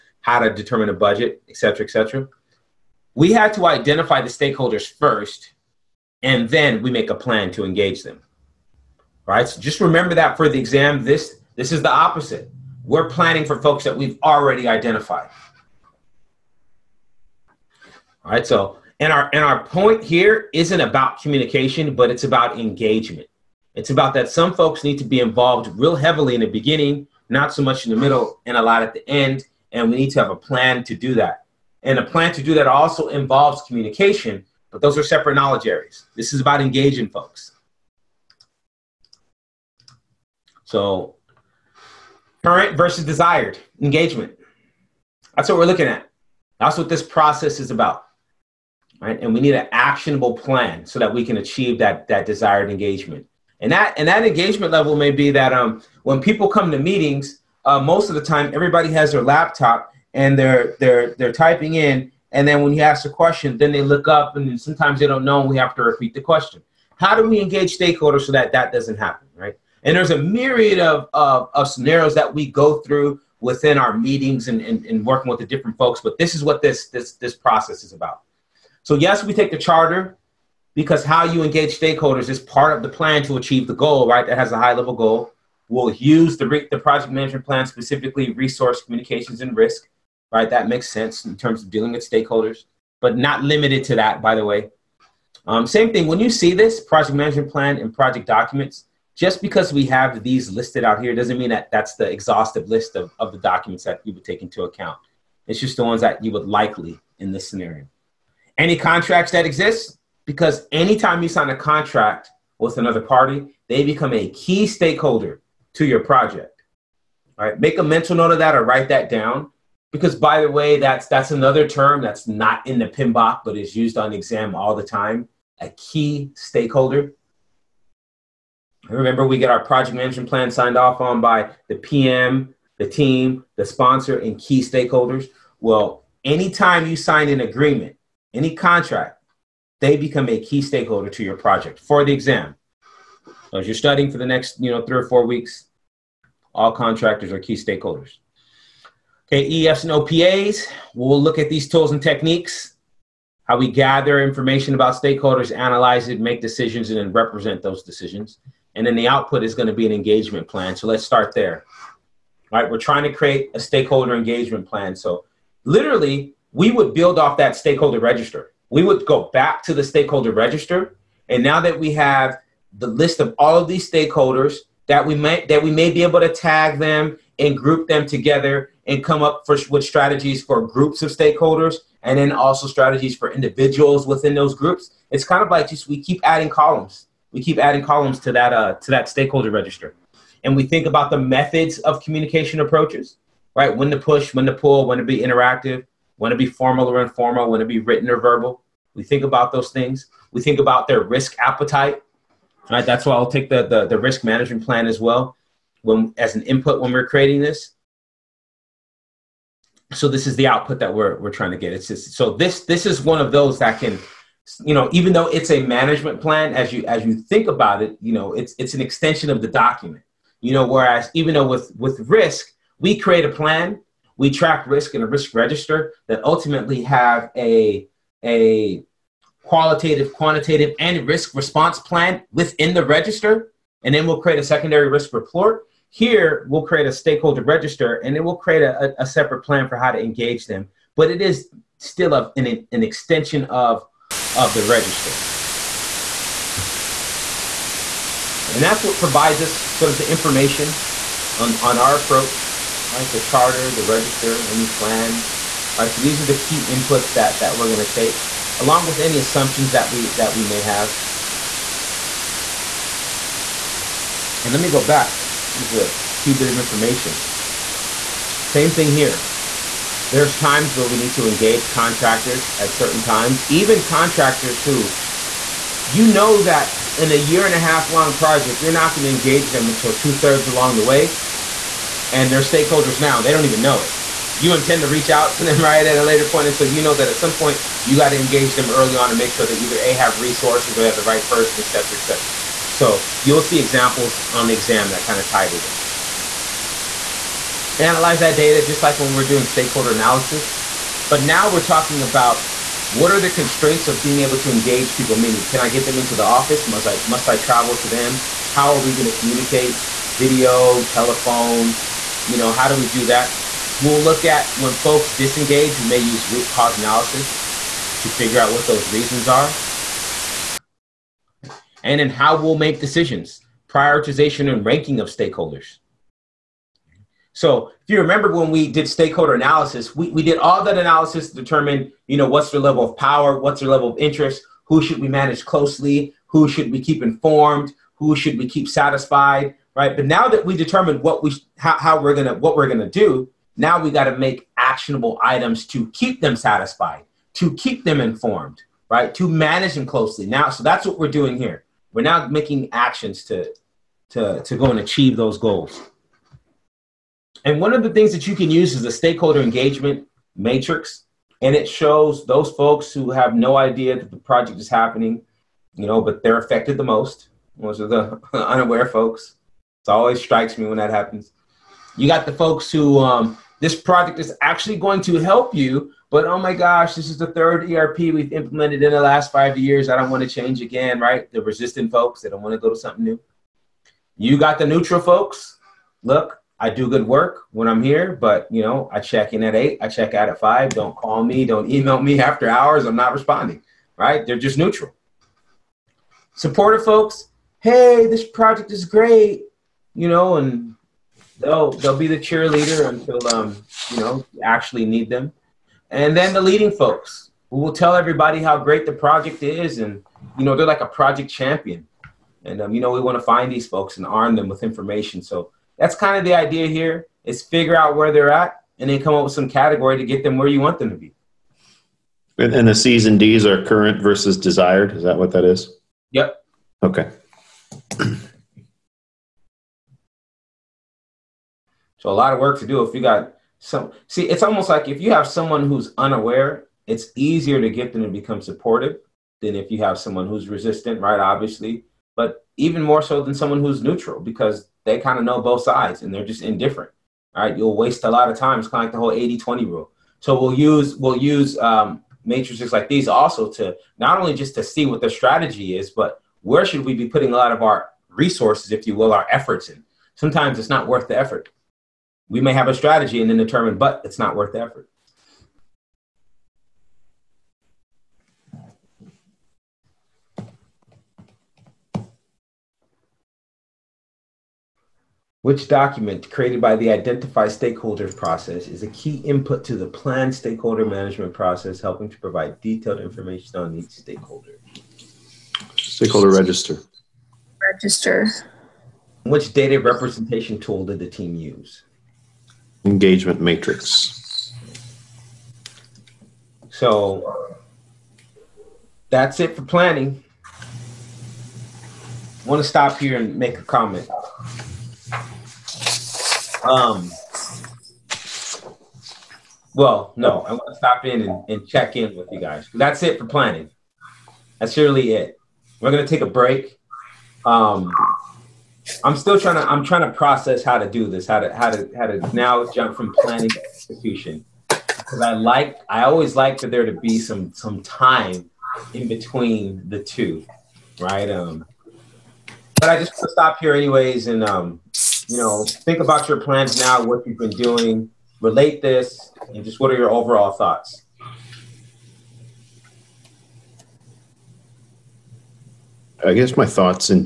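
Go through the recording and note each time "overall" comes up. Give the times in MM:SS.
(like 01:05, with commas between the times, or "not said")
09:00.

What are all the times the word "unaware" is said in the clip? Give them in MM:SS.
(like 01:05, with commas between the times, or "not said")
06:08, 07:15.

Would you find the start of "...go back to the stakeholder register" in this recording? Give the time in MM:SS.
02:49.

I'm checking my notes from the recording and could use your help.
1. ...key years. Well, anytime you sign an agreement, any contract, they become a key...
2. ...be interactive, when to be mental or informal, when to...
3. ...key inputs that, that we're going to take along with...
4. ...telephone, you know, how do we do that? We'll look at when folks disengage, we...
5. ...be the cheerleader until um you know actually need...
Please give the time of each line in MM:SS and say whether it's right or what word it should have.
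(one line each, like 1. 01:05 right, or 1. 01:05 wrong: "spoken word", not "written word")
1. 02:14 wrong: "stakeholders", not "years"
2. 03:15 wrong: "formal", not "mental"
3. 04:16 right
4. 05:10 right
5. 06:41 right.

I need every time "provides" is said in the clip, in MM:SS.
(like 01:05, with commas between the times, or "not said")
04:08, 08:02.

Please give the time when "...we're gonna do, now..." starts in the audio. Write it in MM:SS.
05:42.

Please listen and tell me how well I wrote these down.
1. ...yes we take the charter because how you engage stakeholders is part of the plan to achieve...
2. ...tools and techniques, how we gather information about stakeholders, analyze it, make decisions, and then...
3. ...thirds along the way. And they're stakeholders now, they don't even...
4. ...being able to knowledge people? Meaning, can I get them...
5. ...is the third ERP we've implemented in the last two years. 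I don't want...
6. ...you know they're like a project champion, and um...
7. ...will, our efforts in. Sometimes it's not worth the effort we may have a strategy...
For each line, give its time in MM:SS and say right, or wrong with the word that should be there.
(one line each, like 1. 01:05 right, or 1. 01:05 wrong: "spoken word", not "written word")
1. 01:18 right
2. 02:31 right
3. 04:40 right
4. 05:04 wrong: "engage", not "knowledge"
5. 06:17 wrong: "five", not "two"
6. 06:50 right
7. 07:38 right.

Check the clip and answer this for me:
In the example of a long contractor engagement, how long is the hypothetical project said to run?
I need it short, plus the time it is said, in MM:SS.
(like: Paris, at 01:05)
a year and a half, at 04:37.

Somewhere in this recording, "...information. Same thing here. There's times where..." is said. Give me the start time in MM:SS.
04:26.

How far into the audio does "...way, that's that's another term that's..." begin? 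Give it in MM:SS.
02:00.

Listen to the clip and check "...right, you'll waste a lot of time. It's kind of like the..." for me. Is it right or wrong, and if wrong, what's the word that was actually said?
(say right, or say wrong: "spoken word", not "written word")
right.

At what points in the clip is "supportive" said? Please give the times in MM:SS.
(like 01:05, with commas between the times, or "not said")
06:36, 07:18.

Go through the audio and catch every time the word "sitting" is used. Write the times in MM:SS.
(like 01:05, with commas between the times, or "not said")
not said.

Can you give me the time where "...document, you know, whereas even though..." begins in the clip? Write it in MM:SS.
03:39.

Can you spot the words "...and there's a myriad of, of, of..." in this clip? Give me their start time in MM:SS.
01:09.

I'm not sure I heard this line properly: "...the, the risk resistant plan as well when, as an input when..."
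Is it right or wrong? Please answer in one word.
wrong.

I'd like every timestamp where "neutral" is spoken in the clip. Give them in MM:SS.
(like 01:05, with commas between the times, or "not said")
06:24, 06:34, 07:23.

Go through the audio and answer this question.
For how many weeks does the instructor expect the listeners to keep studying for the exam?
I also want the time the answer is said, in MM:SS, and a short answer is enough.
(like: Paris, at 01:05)
3 or 4 weeks, at 02:24.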